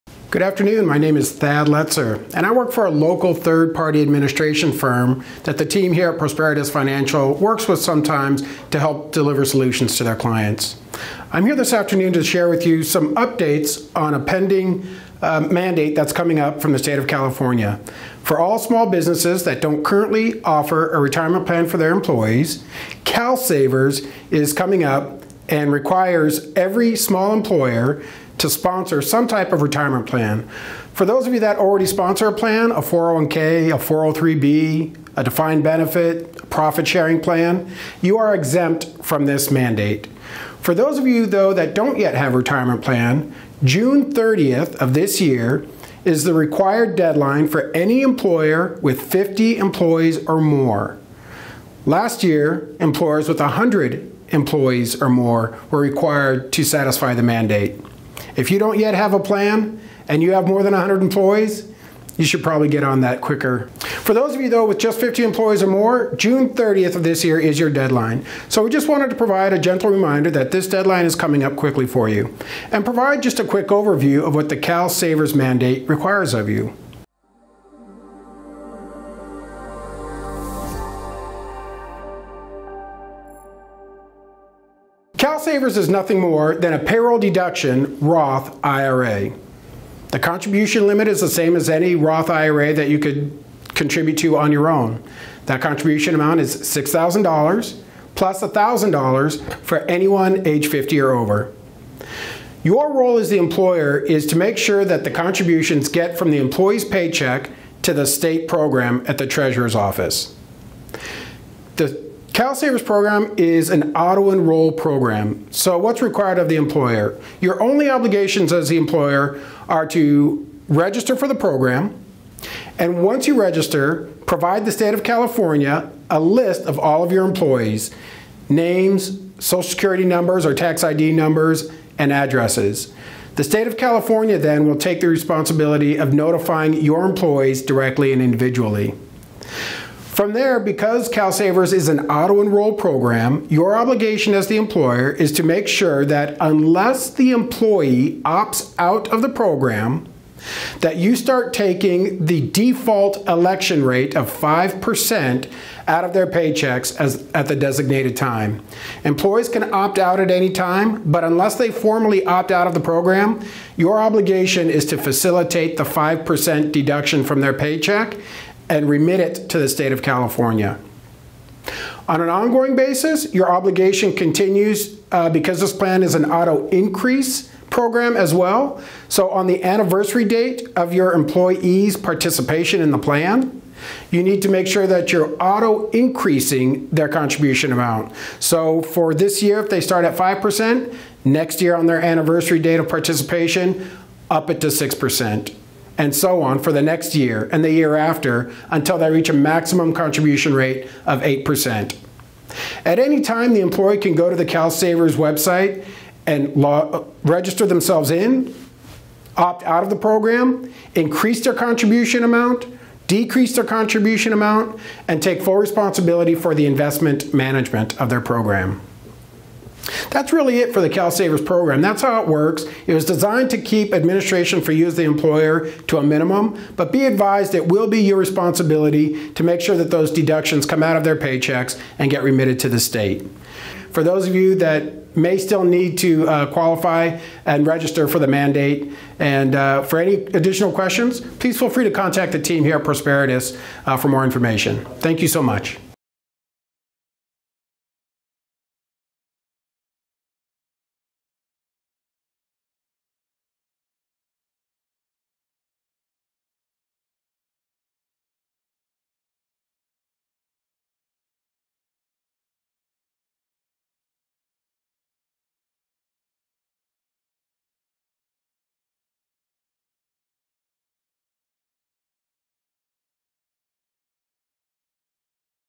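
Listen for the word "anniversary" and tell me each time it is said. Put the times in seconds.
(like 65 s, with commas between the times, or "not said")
179 s, 192 s.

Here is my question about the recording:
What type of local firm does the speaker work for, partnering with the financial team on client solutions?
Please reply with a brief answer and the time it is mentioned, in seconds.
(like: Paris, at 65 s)
third party administration firm, at 3 s.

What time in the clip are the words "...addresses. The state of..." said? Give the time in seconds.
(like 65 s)
132 s.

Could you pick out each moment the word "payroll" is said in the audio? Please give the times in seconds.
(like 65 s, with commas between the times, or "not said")
86 s.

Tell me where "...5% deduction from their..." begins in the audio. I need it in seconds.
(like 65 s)
165 s.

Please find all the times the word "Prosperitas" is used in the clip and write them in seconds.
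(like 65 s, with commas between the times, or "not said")
6 s, 242 s.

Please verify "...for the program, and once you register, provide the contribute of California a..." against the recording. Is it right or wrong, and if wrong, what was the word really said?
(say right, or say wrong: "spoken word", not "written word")
wrong: "state", not "contribute".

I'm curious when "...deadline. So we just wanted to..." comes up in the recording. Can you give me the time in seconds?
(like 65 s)
67 s.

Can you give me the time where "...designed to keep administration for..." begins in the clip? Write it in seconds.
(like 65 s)
223 s.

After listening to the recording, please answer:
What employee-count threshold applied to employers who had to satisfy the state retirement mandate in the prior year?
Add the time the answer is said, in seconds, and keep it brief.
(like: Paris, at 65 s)
100 employees or more, at 53 s.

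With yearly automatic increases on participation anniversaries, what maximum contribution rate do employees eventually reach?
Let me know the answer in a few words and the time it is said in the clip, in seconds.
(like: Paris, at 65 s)
8%, at 201 s.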